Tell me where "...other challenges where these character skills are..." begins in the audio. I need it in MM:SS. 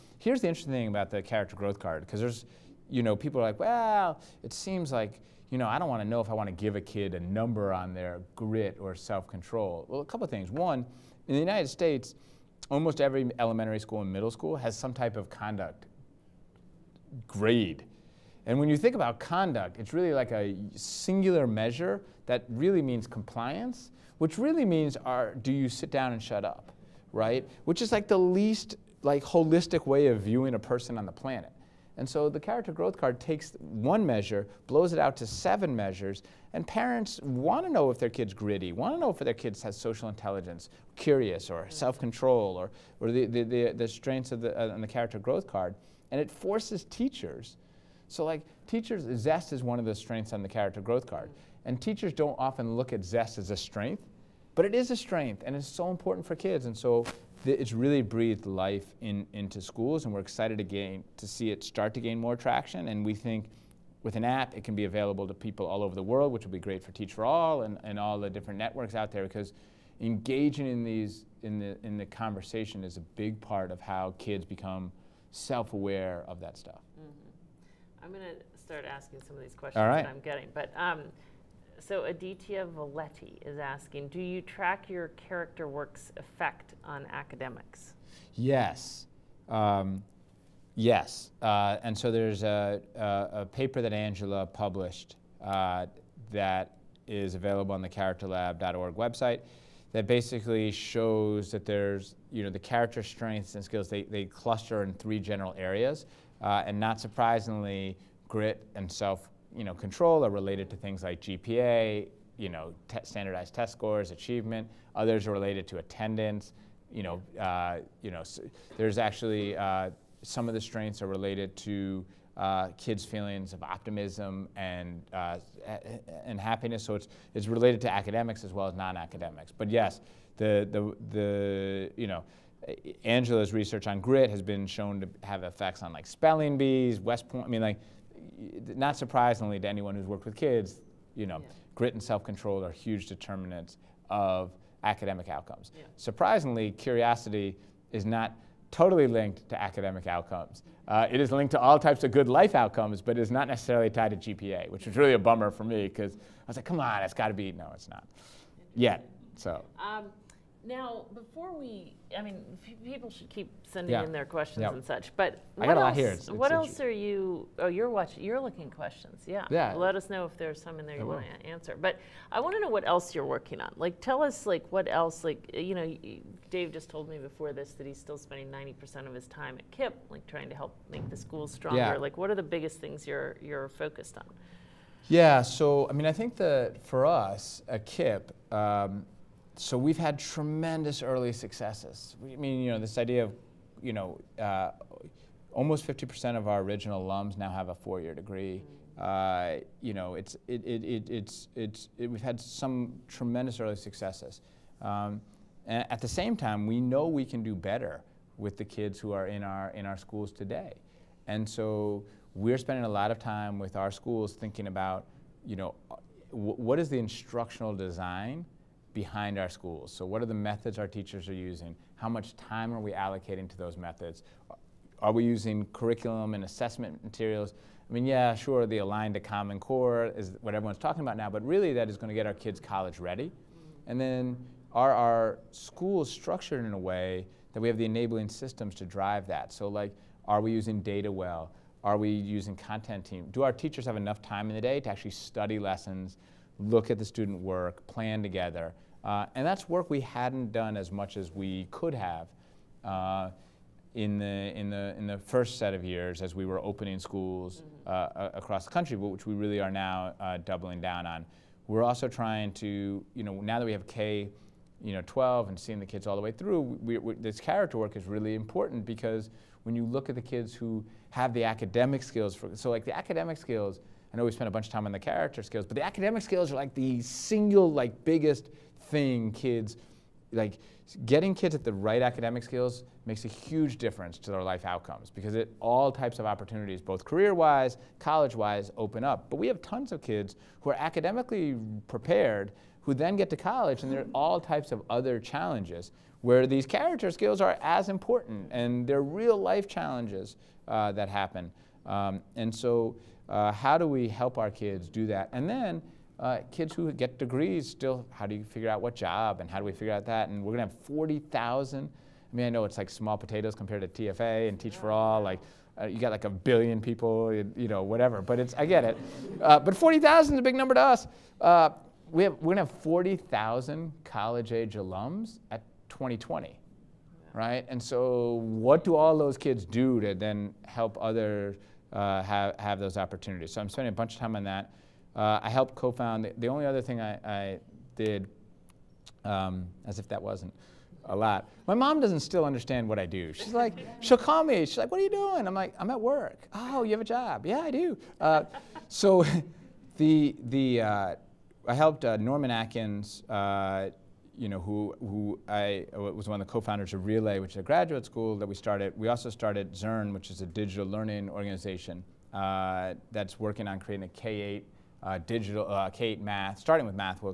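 04:54.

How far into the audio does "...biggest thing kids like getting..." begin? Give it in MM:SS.
04:38.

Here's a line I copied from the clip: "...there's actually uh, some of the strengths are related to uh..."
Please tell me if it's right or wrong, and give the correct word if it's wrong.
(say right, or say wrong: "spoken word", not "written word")
right.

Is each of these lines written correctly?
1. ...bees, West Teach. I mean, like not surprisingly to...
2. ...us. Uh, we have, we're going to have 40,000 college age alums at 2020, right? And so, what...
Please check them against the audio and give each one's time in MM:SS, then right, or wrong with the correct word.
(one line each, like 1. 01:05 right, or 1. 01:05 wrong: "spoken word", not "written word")
1. 02:16 wrong: "Point", not "Teach"
2. 05:20 right.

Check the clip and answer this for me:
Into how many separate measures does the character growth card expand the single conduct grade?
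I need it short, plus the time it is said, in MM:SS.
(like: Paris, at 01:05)
7, at 00:35.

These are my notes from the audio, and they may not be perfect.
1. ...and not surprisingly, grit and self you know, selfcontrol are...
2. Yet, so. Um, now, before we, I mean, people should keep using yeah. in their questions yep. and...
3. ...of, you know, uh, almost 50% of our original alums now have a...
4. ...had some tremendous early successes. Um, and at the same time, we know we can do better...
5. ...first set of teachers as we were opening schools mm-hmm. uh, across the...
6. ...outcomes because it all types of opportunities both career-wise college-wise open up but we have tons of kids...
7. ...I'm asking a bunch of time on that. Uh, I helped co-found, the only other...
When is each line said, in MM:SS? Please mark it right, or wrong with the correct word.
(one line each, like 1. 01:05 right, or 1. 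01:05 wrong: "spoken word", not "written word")
1. 01:46 wrong: "control", not "selfcontrol"
2. 02:38 wrong: "sending", not "using"
3. 03:13 right
4. 03:22 right
5. 04:15 wrong: "years", not "teachers"
6. 04:44 right
7. 05:33 wrong: "spending", not "asking".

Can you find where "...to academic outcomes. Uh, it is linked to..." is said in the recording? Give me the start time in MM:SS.
02:29.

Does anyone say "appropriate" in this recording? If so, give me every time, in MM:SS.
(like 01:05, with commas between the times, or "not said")
not said.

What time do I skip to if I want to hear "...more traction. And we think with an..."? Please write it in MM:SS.
01:02.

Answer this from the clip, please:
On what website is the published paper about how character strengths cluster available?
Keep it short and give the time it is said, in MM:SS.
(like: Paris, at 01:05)
characterlab.org, at 01:37.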